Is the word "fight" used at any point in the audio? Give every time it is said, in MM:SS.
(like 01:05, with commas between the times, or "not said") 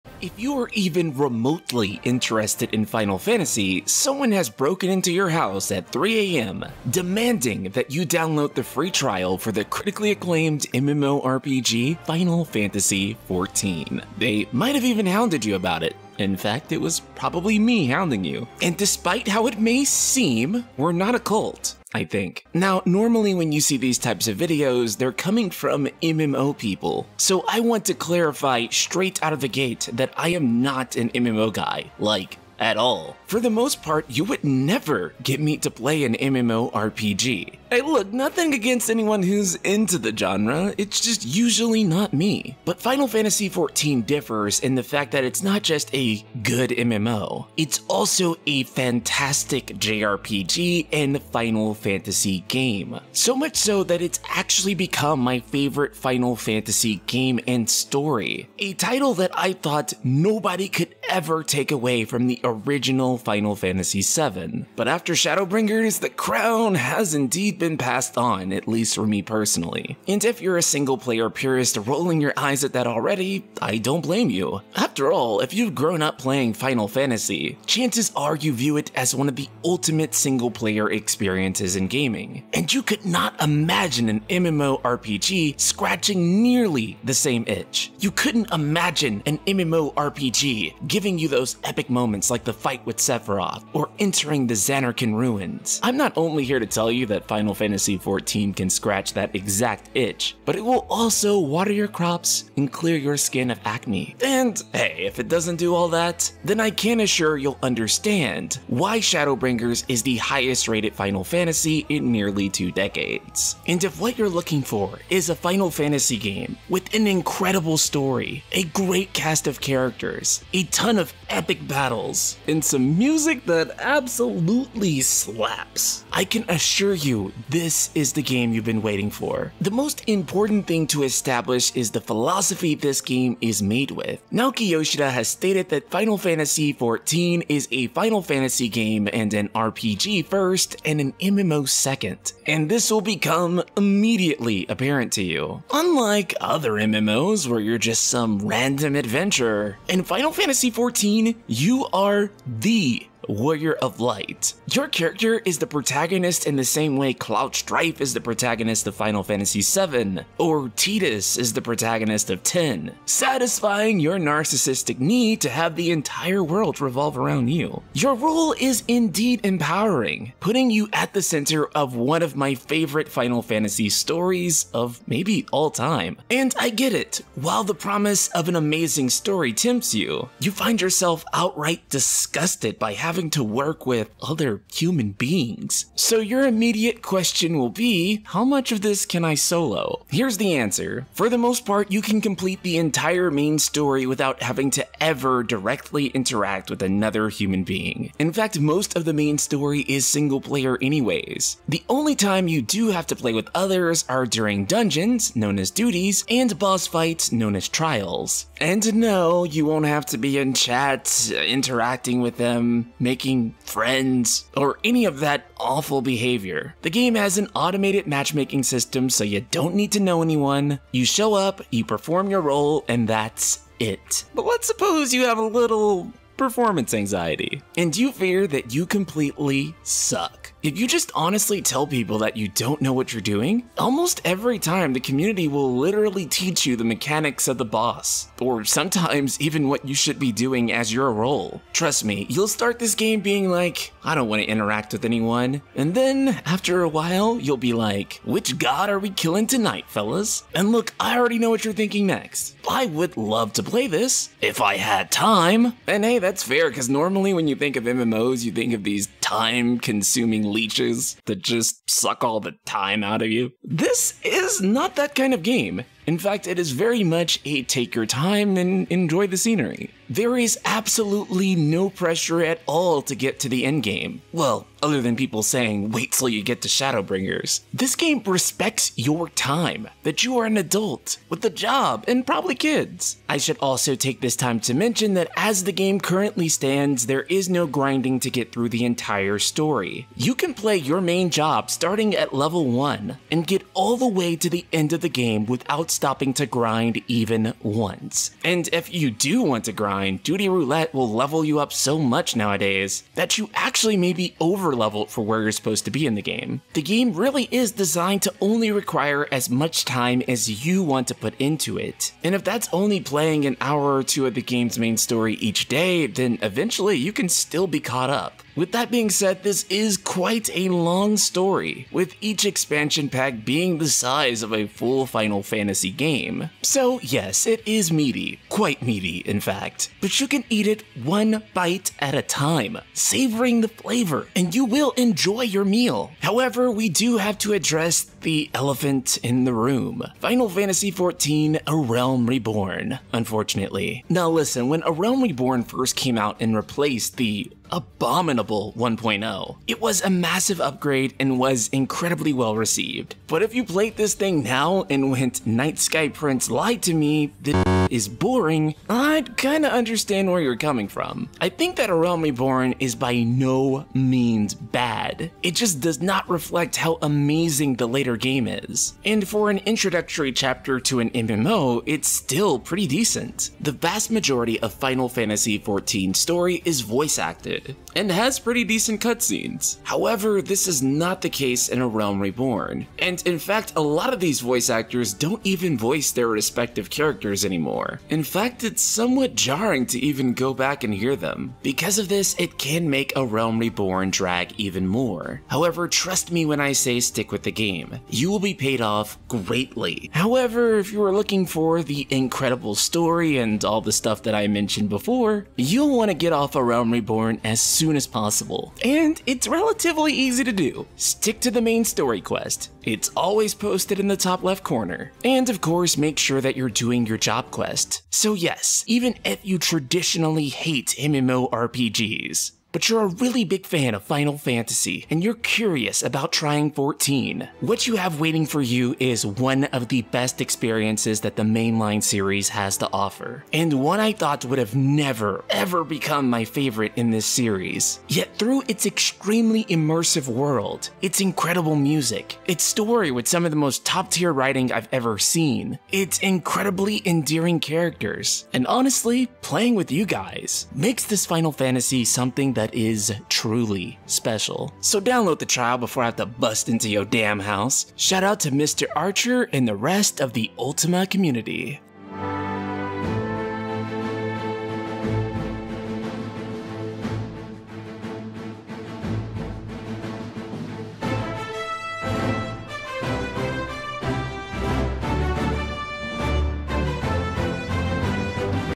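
01:32, 03:26.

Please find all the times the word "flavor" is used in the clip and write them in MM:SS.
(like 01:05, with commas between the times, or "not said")
05:33.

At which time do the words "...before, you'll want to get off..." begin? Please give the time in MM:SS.
06:44.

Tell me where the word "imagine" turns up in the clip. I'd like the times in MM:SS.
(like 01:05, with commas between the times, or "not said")
01:23, 01:28.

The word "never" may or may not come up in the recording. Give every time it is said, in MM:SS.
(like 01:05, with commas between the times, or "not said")
00:34, 07:14.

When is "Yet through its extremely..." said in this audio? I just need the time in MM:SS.
07:18.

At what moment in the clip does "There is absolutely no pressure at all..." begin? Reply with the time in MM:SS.
04:30.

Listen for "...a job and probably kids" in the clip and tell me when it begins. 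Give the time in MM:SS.
04:41.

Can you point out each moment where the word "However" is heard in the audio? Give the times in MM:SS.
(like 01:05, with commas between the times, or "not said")
05:36, 06:19, 06:35, 06:40.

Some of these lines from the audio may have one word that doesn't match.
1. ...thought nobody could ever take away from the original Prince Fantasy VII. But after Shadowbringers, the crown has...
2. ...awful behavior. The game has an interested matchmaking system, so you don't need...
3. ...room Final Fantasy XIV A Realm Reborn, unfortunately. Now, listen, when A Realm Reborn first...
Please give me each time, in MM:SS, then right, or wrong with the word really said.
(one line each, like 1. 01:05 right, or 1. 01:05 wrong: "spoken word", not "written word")
1. 00:59 wrong: "Final", not "Prince"
2. 03:35 wrong: "automated", not "interested"
3. 05:39 right.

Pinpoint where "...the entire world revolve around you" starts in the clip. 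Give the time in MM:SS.
02:45.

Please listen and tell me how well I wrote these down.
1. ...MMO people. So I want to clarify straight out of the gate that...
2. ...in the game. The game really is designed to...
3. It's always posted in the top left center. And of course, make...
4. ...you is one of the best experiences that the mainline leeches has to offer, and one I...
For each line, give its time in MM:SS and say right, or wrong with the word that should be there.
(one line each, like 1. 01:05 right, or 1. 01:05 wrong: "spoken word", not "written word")
1. 00:26 right
2. 05:06 right
3. 06:52 wrong: "corner", not "center"
4. 07:08 wrong: "series", not "leeches".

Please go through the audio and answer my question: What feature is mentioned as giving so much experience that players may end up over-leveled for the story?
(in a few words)
Duty Roulette.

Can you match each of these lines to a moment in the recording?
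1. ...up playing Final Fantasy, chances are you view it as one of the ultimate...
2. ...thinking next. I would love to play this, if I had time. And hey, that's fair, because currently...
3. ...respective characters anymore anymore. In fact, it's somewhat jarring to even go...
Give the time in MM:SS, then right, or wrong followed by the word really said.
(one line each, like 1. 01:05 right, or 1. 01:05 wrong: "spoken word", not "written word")
1. 01:16 right
2. 04:11 wrong: "normally", not "currently"
3. 06:26 right.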